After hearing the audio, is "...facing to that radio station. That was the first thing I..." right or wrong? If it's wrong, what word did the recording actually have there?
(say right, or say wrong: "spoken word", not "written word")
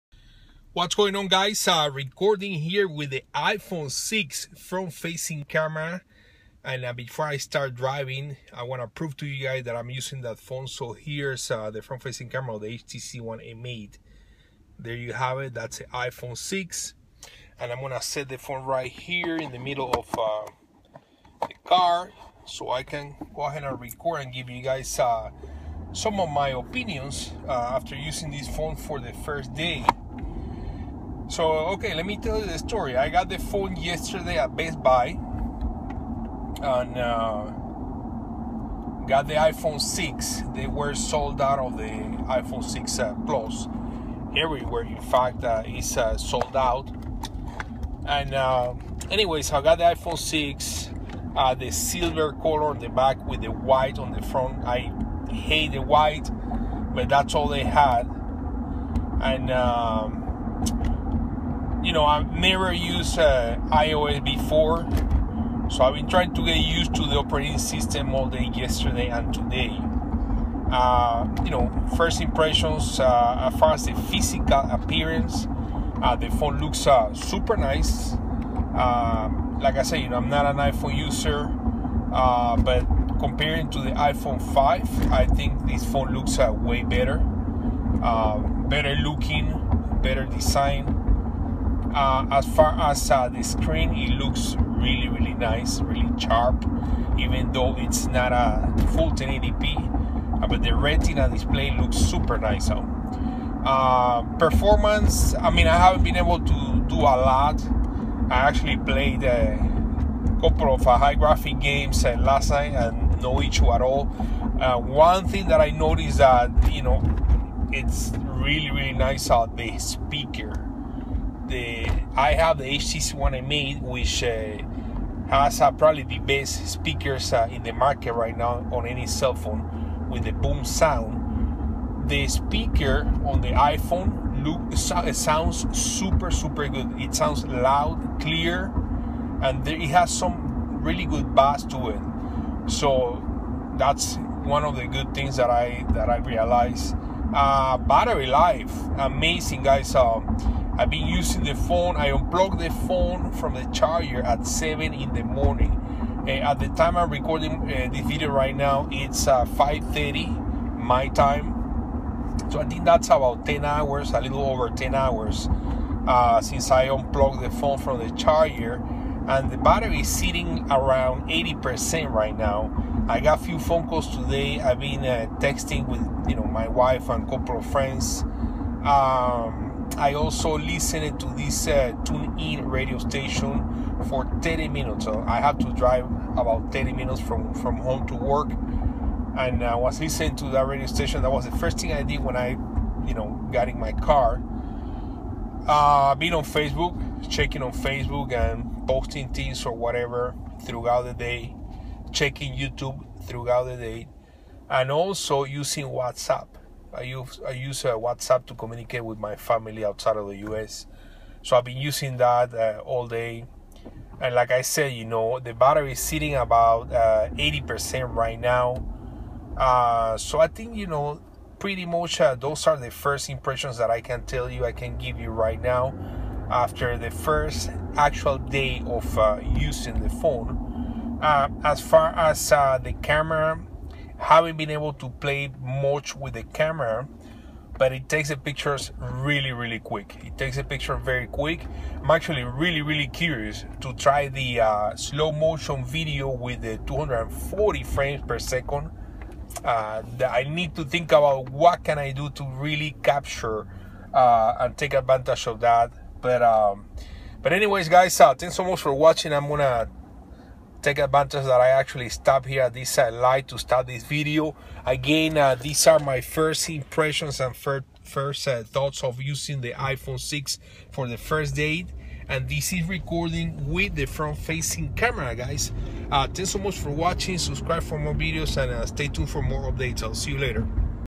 wrong: "listening", not "facing".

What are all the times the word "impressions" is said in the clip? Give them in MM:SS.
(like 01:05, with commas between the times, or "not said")
01:12, 03:43, 04:26.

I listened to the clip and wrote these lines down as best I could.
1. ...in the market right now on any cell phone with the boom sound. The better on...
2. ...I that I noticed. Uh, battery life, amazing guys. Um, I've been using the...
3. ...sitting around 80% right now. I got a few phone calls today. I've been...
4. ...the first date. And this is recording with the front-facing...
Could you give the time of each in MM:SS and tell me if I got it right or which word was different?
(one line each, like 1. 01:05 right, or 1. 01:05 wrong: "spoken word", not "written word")
1. 02:07 wrong: "speaker", not "better"
2. 02:25 wrong: "realized", not "noticed"
3. 02:50 right
4. 04:31 right.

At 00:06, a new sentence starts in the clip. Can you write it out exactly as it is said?
And uh, before I start driving, I want to prove to you guys that I'm using that phone.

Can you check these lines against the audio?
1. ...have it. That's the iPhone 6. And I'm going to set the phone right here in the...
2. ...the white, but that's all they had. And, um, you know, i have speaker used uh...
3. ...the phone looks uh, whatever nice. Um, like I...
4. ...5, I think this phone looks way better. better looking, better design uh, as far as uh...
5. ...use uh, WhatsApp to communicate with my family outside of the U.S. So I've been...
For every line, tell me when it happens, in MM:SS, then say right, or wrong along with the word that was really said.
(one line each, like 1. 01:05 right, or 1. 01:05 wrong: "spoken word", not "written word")
1. 00:15 right
2. 00:55 wrong: "never", not "speaker"
3. 01:16 wrong: "super", not "whatever"
4. 01:24 right
5. 03:27 right.